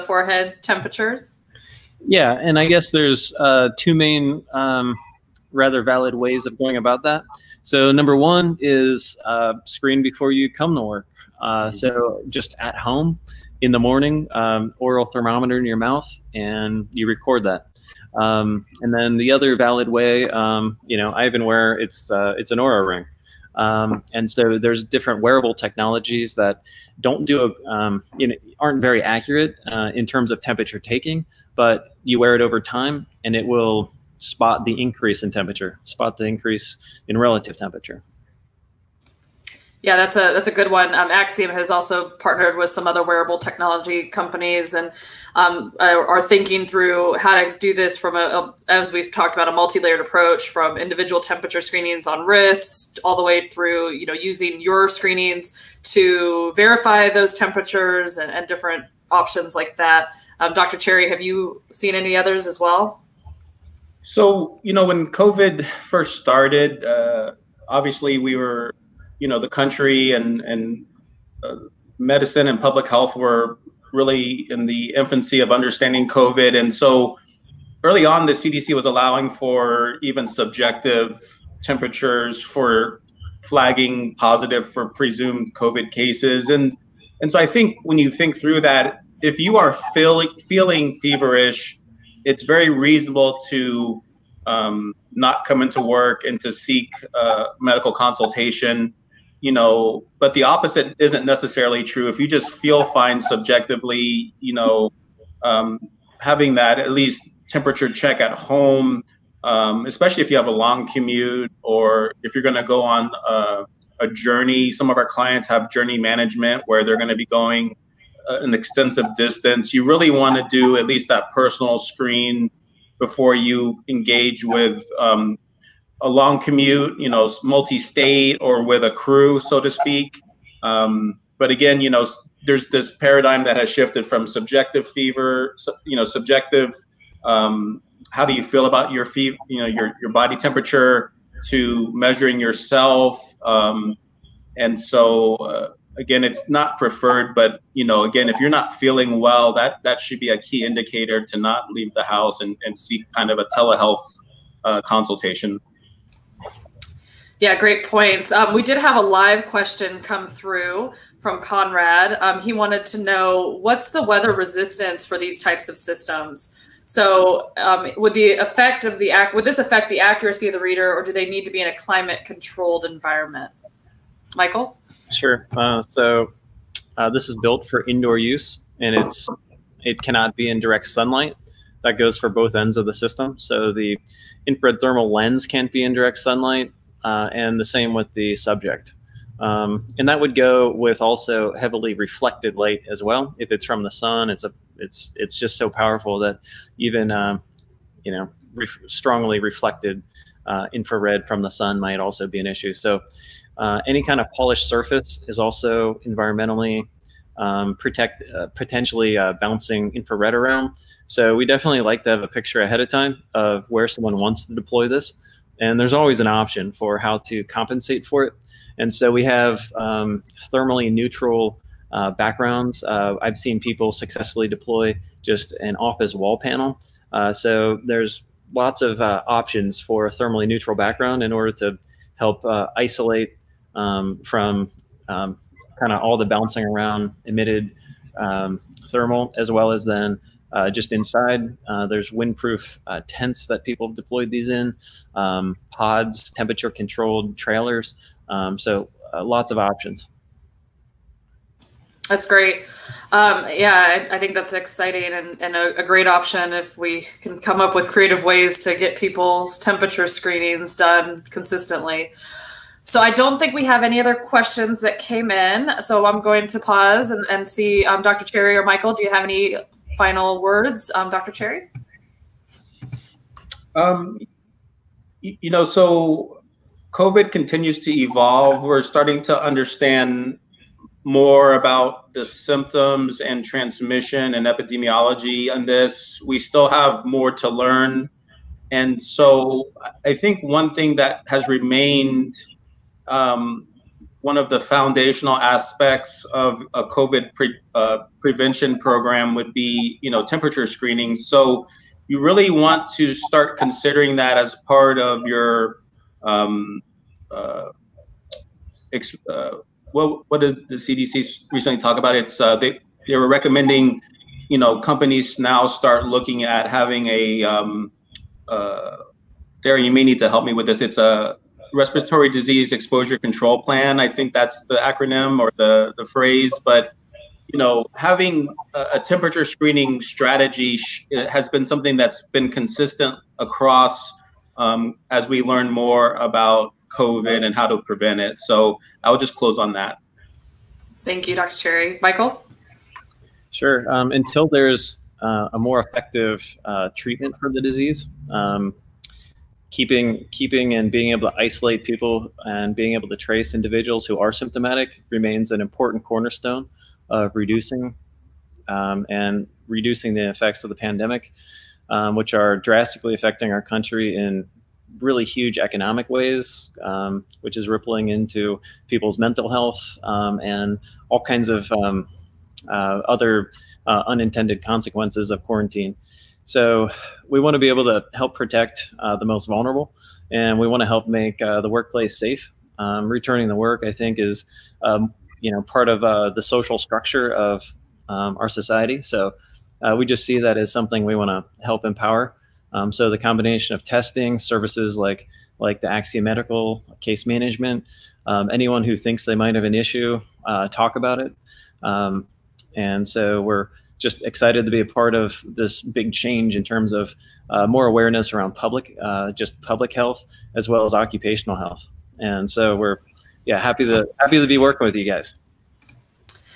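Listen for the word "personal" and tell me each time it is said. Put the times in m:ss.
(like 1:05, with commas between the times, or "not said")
2:01.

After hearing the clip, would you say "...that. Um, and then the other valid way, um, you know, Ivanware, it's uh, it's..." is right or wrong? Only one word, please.
right.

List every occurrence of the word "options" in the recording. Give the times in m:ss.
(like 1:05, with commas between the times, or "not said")
0:59, 3:36, 3:49, 4:09, 4:16.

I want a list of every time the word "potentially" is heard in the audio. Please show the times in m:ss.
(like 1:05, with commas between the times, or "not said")
3:28.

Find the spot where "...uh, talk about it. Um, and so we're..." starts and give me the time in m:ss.
6:40.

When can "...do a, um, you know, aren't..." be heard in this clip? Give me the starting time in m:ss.
0:27.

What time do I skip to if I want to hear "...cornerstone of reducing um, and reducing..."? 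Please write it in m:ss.
5:56.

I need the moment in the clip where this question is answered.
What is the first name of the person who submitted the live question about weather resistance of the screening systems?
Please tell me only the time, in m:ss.
2:41.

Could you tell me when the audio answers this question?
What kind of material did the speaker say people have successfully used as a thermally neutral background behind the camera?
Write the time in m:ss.
3:45.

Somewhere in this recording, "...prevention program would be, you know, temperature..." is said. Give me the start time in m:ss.
4:58.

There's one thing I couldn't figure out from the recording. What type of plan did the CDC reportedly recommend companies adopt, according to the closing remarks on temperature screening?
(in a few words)
respiratory disease exposure control plan.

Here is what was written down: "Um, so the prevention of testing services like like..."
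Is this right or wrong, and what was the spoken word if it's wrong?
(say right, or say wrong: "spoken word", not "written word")
wrong: "combination", not "prevention".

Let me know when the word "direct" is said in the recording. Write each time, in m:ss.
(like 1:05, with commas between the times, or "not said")
3:00, 3:05.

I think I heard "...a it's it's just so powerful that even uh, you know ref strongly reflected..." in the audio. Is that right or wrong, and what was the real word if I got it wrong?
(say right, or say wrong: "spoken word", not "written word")
right.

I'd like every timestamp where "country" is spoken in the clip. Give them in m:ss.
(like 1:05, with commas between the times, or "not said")
1:09, 6:03.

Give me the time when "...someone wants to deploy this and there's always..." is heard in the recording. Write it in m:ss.
3:33.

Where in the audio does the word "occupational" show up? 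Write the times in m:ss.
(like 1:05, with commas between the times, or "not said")
6:50.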